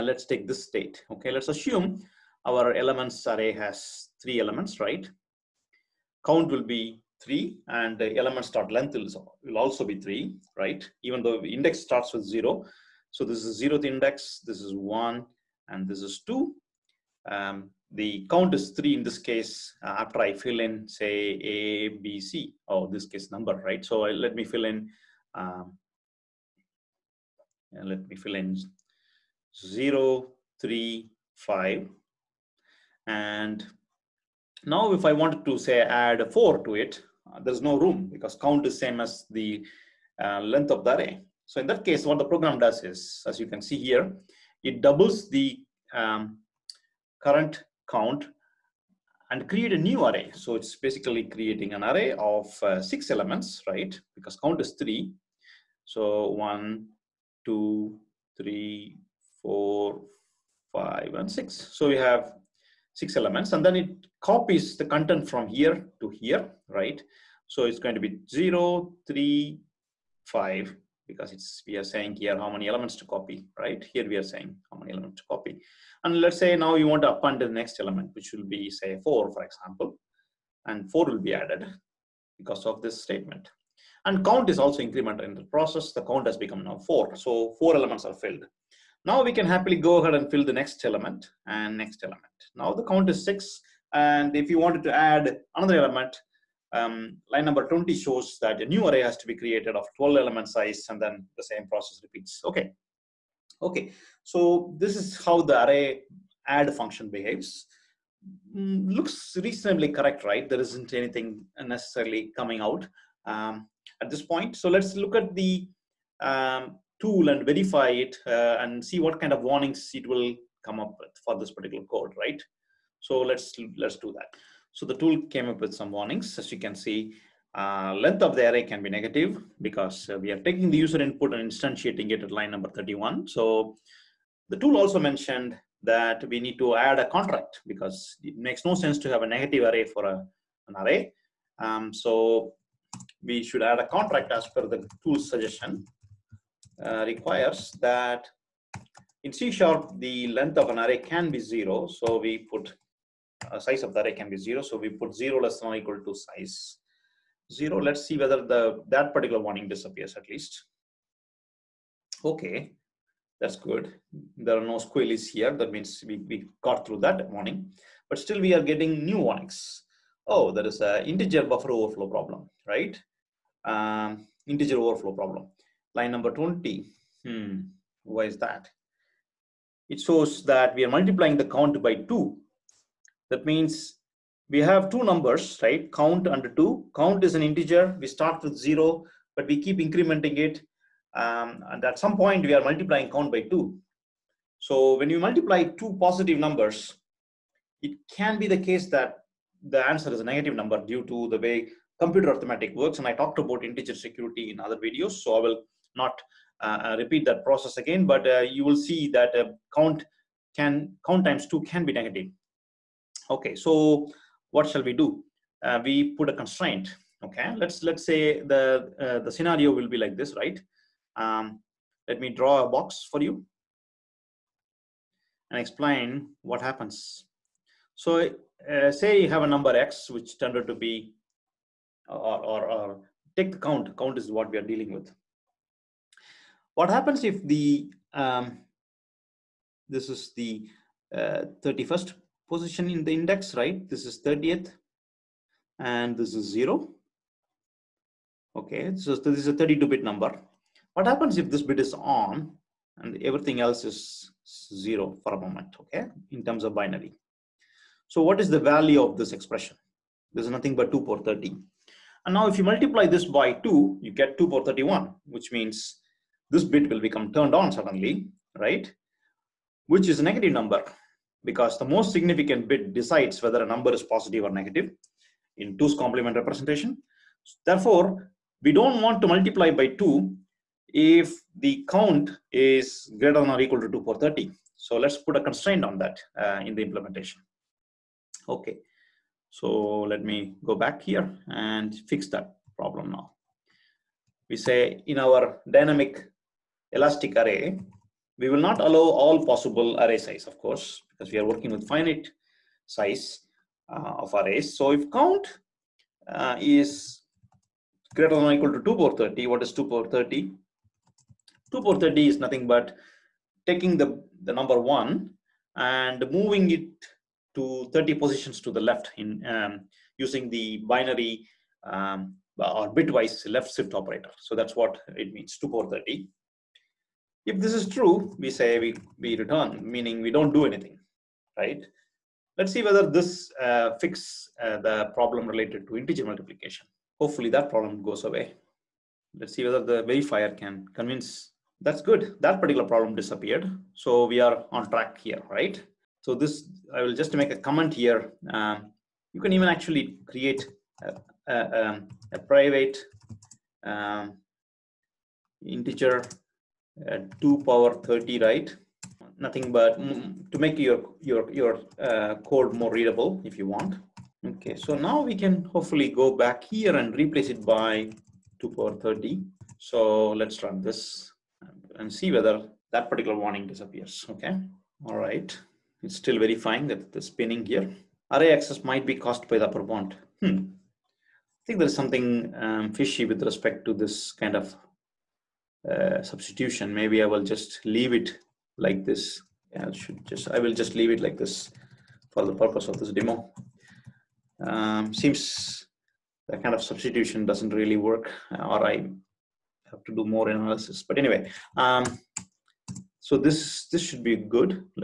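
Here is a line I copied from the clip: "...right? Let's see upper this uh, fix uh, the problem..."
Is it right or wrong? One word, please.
wrong.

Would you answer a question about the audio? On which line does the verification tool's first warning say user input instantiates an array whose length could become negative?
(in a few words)
31.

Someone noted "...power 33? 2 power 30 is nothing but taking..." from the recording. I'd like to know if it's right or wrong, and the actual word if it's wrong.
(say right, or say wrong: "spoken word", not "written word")
wrong: "30", not "33".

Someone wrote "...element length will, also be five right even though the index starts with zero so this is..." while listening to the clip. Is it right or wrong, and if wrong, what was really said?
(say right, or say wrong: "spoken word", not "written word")
wrong: "three", not "five".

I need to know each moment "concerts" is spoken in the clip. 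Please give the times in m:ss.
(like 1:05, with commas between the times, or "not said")
not said.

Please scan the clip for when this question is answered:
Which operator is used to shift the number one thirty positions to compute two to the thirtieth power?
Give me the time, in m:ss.
5:22.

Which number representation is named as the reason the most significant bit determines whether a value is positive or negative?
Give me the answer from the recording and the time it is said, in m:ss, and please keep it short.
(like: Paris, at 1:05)
2's complement, at 4:35.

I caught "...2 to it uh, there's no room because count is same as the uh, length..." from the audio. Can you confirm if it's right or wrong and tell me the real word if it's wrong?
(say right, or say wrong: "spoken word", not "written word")
wrong: "4", not "2".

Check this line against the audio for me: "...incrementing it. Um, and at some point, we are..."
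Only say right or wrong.
right.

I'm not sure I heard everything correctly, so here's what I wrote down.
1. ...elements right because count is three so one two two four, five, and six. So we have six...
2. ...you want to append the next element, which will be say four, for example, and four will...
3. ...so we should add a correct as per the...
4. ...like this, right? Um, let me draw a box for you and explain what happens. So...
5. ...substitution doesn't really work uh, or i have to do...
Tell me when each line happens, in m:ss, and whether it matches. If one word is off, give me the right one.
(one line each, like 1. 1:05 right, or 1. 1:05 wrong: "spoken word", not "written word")
1. 0:53 wrong: "three", not "two"
2. 1:16 right
3. 2:21 wrong: "contract", not "correct"
4. 3:40 right
5. 6:36 right.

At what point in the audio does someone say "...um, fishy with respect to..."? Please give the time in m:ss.
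6:22.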